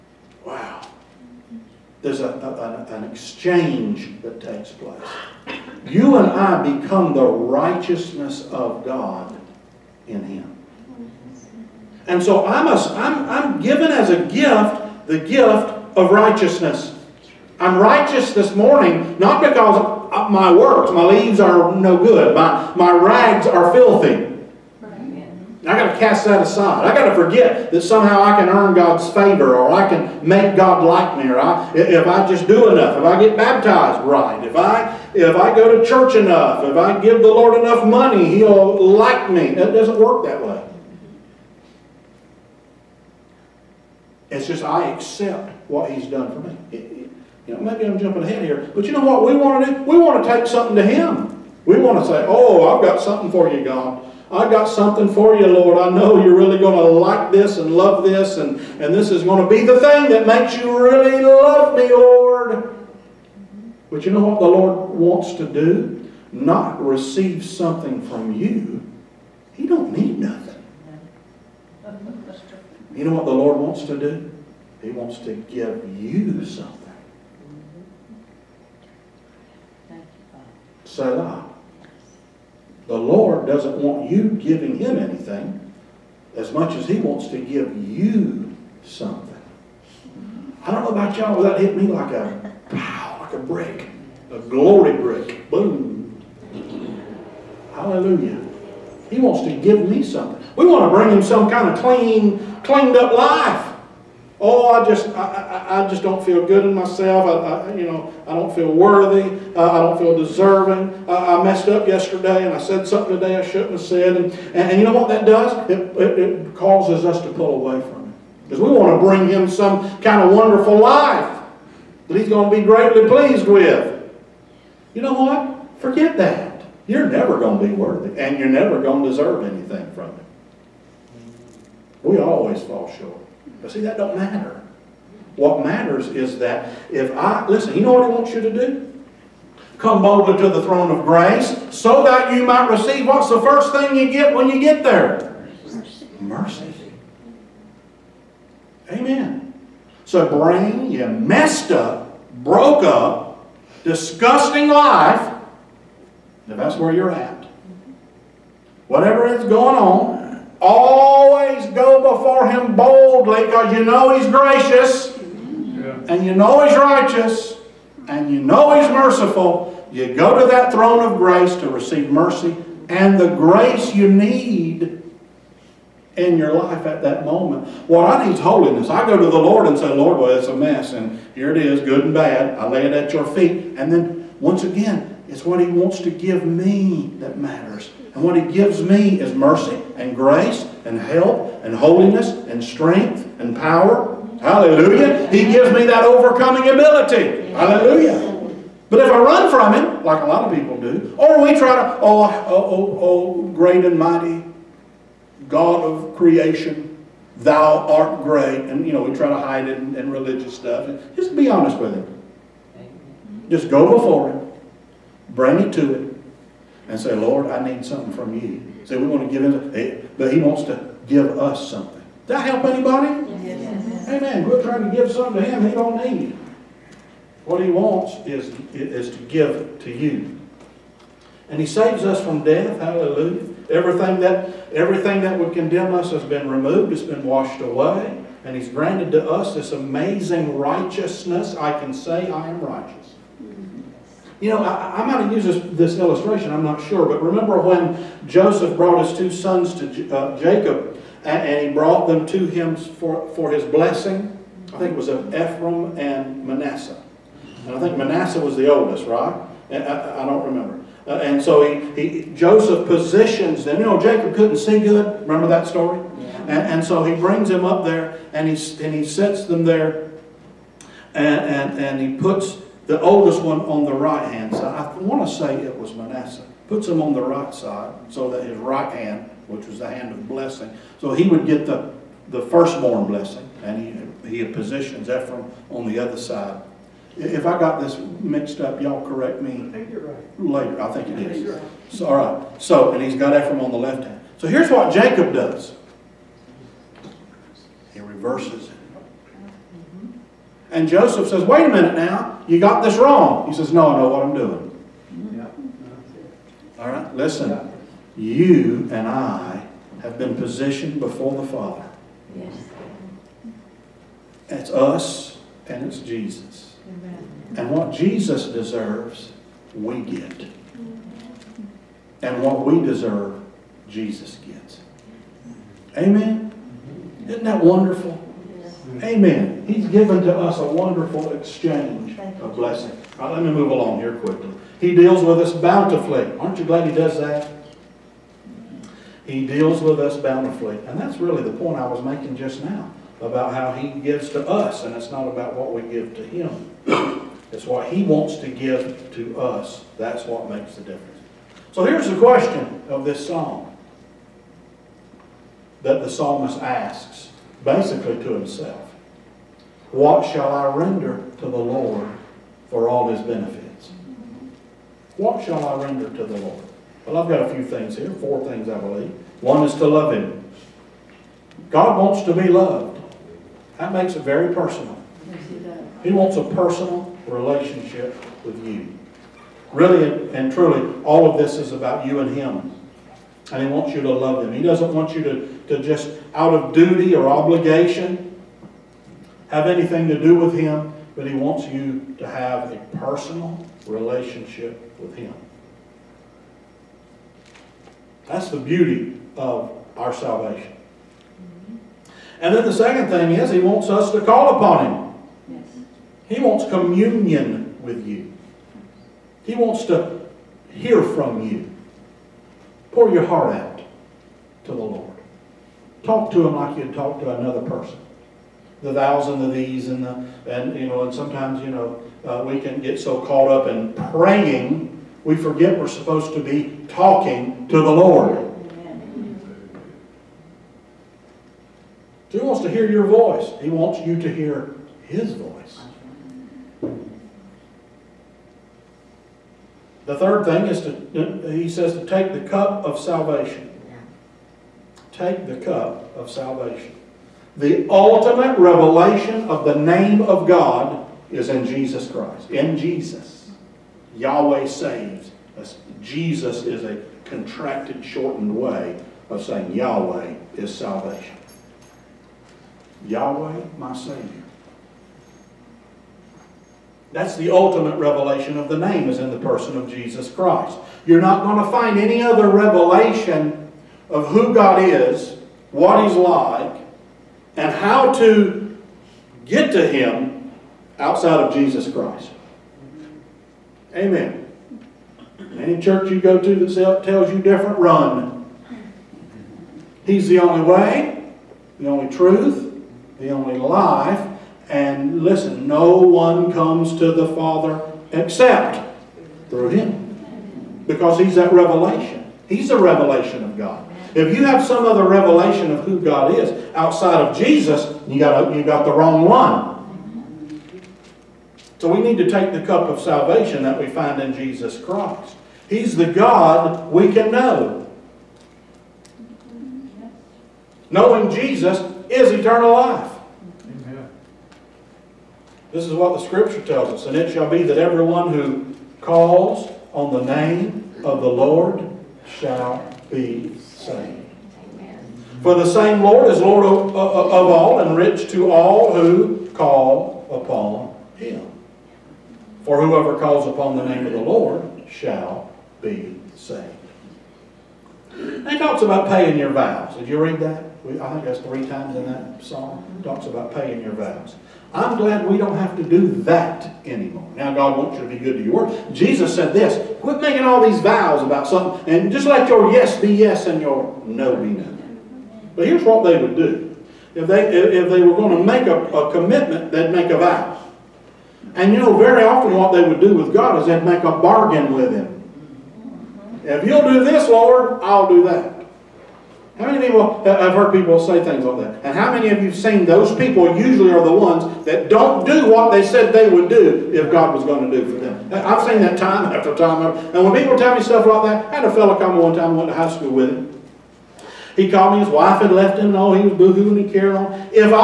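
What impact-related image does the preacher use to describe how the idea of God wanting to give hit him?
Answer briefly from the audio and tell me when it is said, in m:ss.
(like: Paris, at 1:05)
A glory brick, at 1:34.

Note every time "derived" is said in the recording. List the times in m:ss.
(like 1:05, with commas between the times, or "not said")
not said.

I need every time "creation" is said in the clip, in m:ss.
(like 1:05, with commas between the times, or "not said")
3:26.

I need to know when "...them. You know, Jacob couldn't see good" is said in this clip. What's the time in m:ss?
4:23.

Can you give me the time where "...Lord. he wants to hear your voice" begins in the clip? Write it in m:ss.
7:07.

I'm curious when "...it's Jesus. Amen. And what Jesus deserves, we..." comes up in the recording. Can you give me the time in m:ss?
5:15.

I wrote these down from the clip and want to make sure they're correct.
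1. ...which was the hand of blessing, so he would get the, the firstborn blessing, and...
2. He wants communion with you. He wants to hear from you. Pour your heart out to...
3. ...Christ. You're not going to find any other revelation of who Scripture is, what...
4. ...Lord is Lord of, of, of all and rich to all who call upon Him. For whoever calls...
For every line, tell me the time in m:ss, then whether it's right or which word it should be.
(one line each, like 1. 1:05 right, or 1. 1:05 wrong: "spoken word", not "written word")
1. 4:39 right
2. 6:46 right
3. 7:50 wrong: "God", not "Scripture"
4. 8:56 right.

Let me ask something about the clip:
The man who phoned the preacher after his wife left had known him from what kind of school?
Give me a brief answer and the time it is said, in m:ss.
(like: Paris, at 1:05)
High school, at 9:52.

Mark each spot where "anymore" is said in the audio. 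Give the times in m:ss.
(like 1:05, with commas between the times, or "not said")
9:16.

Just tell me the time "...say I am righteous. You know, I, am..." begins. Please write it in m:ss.
4:01.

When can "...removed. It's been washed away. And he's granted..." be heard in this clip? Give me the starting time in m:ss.
3:56.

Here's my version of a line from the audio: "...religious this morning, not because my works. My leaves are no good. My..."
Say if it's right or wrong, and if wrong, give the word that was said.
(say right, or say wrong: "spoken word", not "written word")
wrong: "righteous", not "religious".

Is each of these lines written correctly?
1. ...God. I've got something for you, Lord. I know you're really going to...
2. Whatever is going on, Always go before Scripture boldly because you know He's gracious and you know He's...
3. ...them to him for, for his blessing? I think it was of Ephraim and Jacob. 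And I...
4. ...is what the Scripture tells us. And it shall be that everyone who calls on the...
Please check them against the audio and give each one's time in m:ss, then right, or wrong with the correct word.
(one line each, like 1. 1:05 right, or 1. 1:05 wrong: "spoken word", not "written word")
1. 0:53 right
2. 2:38 wrong: "Him", not "Scripture"
3. 4:12 wrong: "Manasseh", not "Jacob"
4. 8:45 right.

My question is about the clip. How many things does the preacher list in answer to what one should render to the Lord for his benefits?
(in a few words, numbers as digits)
4.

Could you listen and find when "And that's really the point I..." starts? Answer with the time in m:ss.
5:40.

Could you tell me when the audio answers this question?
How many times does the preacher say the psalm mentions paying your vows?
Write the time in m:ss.
9:11.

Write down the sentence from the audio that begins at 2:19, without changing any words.
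Come boldly to the throne of grace so that you might receive what's the first thing you get when you get there?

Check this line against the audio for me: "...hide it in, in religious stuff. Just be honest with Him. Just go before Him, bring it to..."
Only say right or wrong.
right.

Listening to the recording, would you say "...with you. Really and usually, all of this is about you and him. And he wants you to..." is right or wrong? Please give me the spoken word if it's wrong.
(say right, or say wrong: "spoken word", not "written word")
wrong: "truly", not "usually".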